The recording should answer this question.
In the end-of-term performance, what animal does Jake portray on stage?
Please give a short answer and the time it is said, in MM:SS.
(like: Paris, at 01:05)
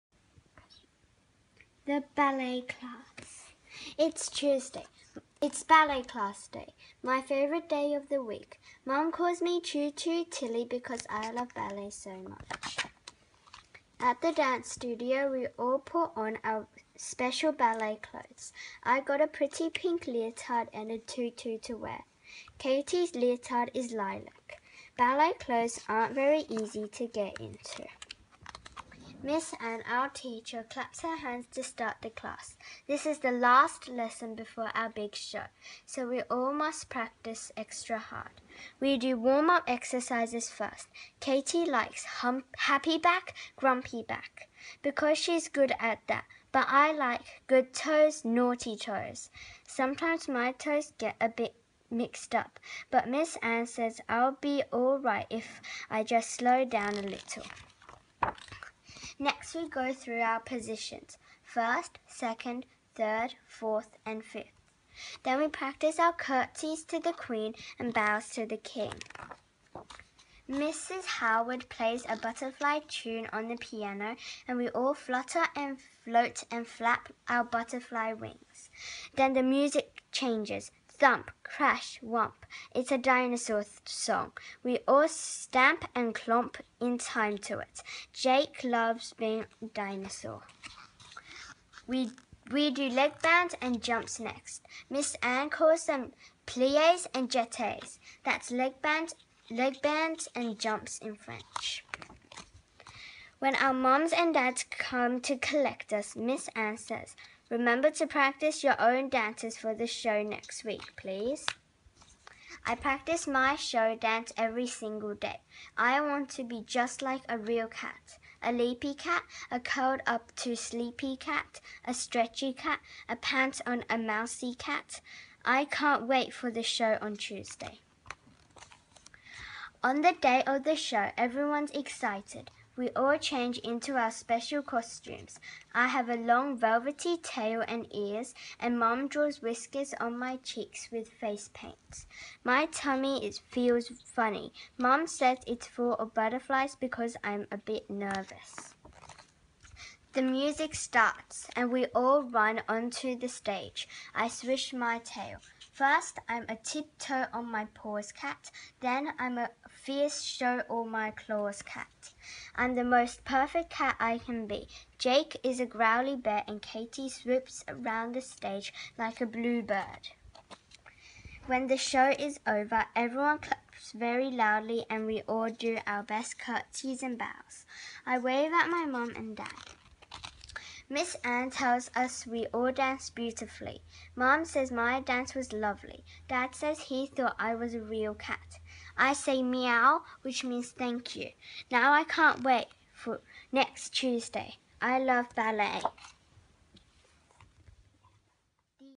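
A growly bear, at 02:45.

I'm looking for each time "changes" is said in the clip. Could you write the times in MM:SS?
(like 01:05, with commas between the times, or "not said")
01:20, 02:13.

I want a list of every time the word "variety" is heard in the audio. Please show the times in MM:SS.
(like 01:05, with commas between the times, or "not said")
not said.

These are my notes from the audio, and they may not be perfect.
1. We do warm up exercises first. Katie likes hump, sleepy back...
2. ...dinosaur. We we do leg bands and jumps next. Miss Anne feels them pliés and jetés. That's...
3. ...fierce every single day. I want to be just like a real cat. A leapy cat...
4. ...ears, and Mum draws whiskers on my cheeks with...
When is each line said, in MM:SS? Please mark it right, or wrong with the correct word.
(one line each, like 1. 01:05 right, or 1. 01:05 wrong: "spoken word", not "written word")
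1. 00:38 wrong: "happy", not "sleepy"
2. 01:29 wrong: "calls", not "feels"
3. 01:53 wrong: "dance", not "fierce"
4. 02:17 right.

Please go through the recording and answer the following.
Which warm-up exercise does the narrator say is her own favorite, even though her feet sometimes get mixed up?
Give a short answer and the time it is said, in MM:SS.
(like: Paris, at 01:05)
Good toes, naughty toes, at 00:47.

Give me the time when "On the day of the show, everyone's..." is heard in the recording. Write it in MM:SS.
02:09.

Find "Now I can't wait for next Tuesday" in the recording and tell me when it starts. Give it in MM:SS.
03:11.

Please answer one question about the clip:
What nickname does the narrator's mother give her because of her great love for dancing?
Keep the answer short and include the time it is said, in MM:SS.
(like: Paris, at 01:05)
Tutu Tilly, at 00:09.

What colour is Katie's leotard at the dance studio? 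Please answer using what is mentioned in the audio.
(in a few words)
Lilac.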